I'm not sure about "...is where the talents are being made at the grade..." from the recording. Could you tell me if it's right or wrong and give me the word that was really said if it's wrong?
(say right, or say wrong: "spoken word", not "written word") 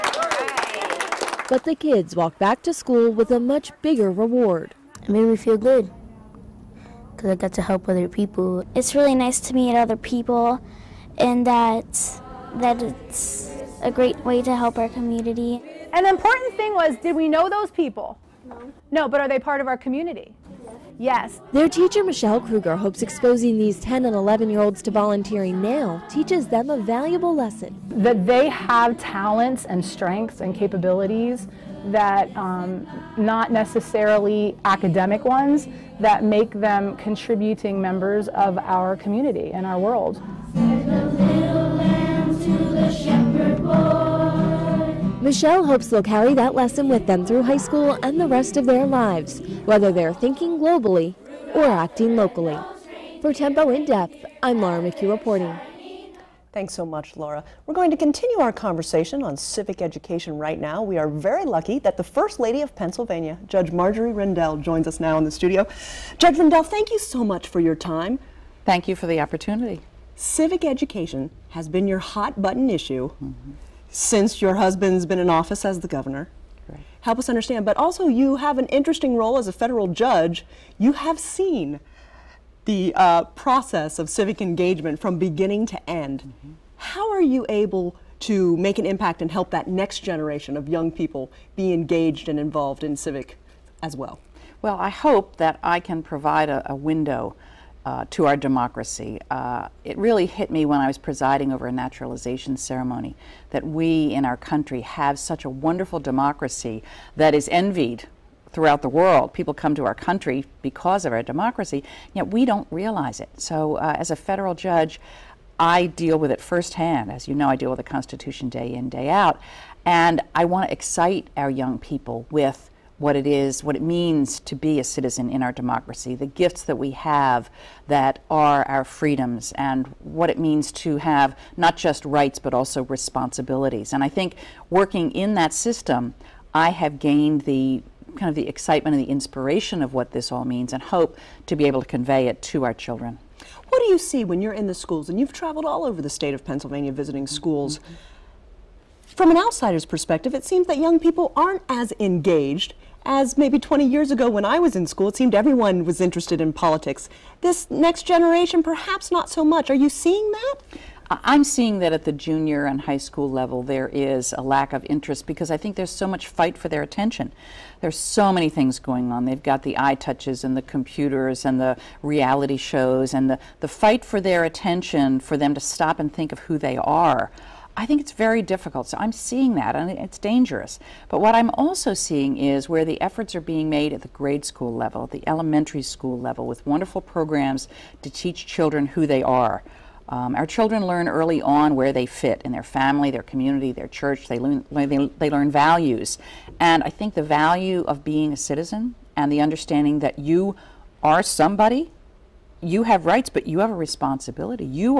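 wrong: "efforts", not "talents".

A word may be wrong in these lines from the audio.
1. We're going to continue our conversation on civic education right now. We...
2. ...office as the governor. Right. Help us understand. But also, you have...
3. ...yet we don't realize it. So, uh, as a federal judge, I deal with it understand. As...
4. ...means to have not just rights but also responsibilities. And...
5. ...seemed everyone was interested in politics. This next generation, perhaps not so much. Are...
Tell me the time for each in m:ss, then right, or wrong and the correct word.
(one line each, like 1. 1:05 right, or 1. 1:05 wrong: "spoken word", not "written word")
1. 0:57 right
2. 1:15 right
3. 1:52 wrong: "firsthand", not "understand"
4. 2:10 right
5. 2:35 right.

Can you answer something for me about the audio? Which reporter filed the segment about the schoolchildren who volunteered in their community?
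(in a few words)
Laura McHugh.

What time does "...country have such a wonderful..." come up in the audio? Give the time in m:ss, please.
1:44.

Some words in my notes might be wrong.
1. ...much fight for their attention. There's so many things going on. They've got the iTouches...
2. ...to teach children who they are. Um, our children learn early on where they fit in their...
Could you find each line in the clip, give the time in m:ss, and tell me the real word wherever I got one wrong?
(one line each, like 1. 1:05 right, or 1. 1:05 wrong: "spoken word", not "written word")
1. 2:46 right
2. 3:08 right.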